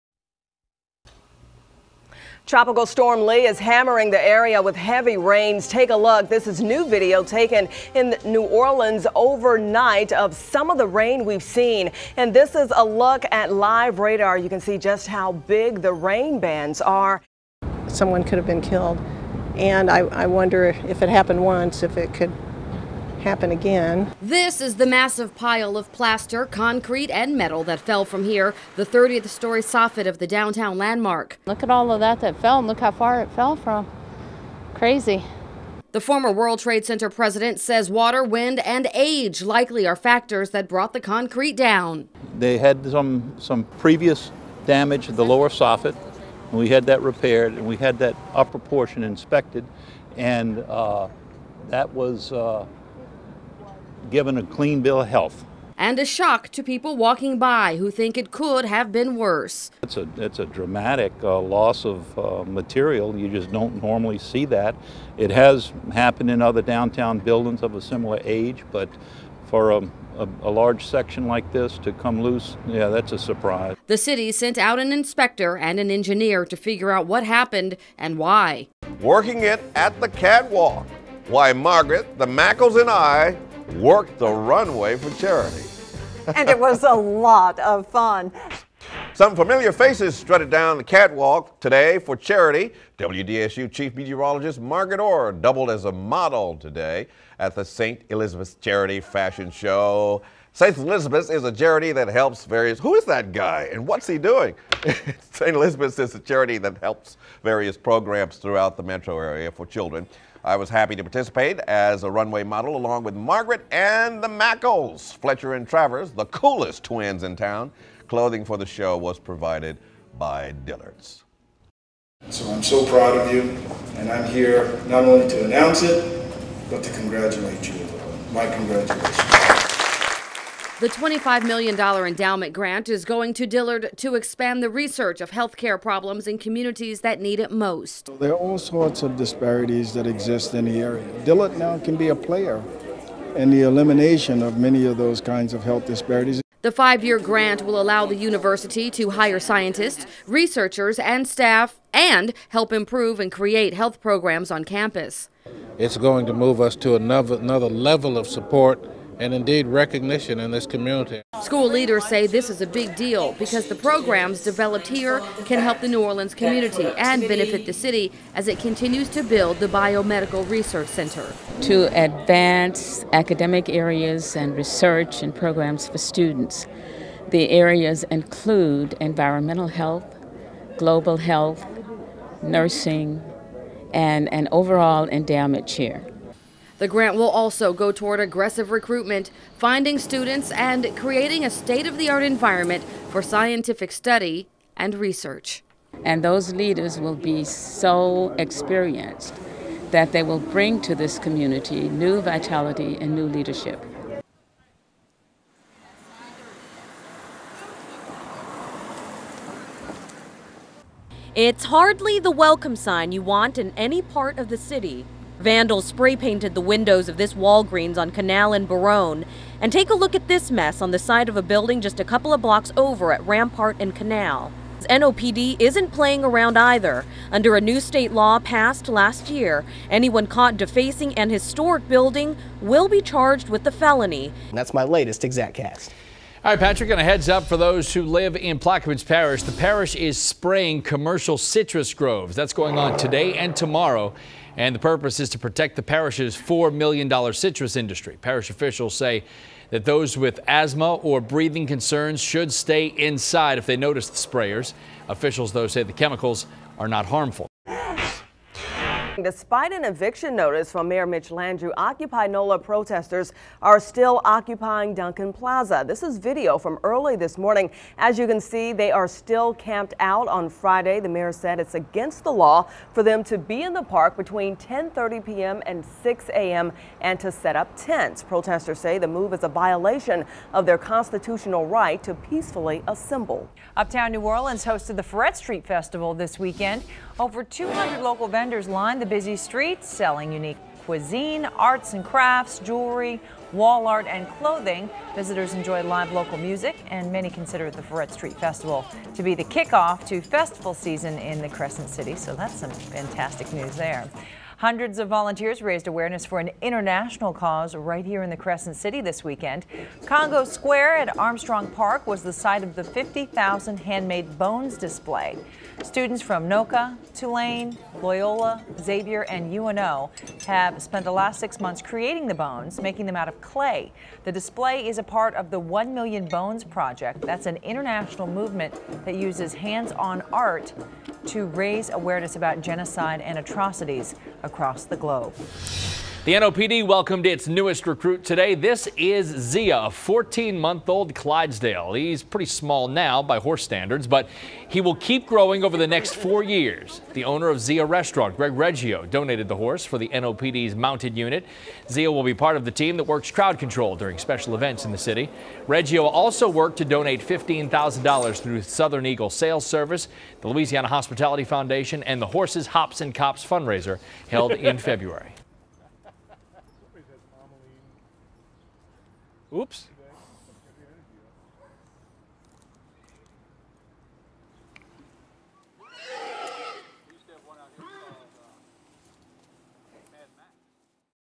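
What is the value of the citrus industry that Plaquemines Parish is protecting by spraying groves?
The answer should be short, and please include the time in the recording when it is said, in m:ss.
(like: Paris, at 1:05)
$4 million, at 4:06.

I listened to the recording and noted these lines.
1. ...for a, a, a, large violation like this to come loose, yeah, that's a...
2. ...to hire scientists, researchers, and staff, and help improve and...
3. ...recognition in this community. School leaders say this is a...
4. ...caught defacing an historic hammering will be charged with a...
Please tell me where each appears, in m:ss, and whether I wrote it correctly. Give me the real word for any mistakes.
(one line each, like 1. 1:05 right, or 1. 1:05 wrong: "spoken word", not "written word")
1. 1:09 wrong: "section", not "violation"
2. 2:28 right
3. 2:39 right
4. 3:50 wrong: "building", not "hammering".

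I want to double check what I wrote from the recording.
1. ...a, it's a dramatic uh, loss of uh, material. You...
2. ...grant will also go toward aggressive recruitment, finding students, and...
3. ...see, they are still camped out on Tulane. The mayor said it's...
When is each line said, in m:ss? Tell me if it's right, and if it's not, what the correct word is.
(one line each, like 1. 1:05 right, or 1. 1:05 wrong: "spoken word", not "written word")
1. 0:59 right
2. 3:06 right
3. 4:28 wrong: "Friday", not "Tulane".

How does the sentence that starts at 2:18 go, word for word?
There are all sorts of disparities that exist in the area.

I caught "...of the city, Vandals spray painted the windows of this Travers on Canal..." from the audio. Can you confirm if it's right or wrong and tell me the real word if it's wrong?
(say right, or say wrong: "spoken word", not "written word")
wrong: "Walgreens", not "Travers".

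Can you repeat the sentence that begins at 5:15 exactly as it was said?
Students from NOCCA, Tulane, Loyola, Xavier, and UNO have spent the last six months creating the bones, making them out of clay.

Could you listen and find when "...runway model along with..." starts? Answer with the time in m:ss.
1:52.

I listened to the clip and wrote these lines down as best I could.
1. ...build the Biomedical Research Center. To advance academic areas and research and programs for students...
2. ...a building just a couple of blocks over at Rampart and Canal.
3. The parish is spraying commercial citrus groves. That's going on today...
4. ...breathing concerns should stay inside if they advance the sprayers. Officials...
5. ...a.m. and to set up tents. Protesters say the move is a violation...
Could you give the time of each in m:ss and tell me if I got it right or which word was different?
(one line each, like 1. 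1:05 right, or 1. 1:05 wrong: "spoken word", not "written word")
1. 2:49 right
2. 3:41 right
3. 3:59 right
4. 4:11 wrong: "notice", not "advance"
5. 4:36 right.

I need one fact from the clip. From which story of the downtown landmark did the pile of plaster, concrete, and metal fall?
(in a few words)
30th.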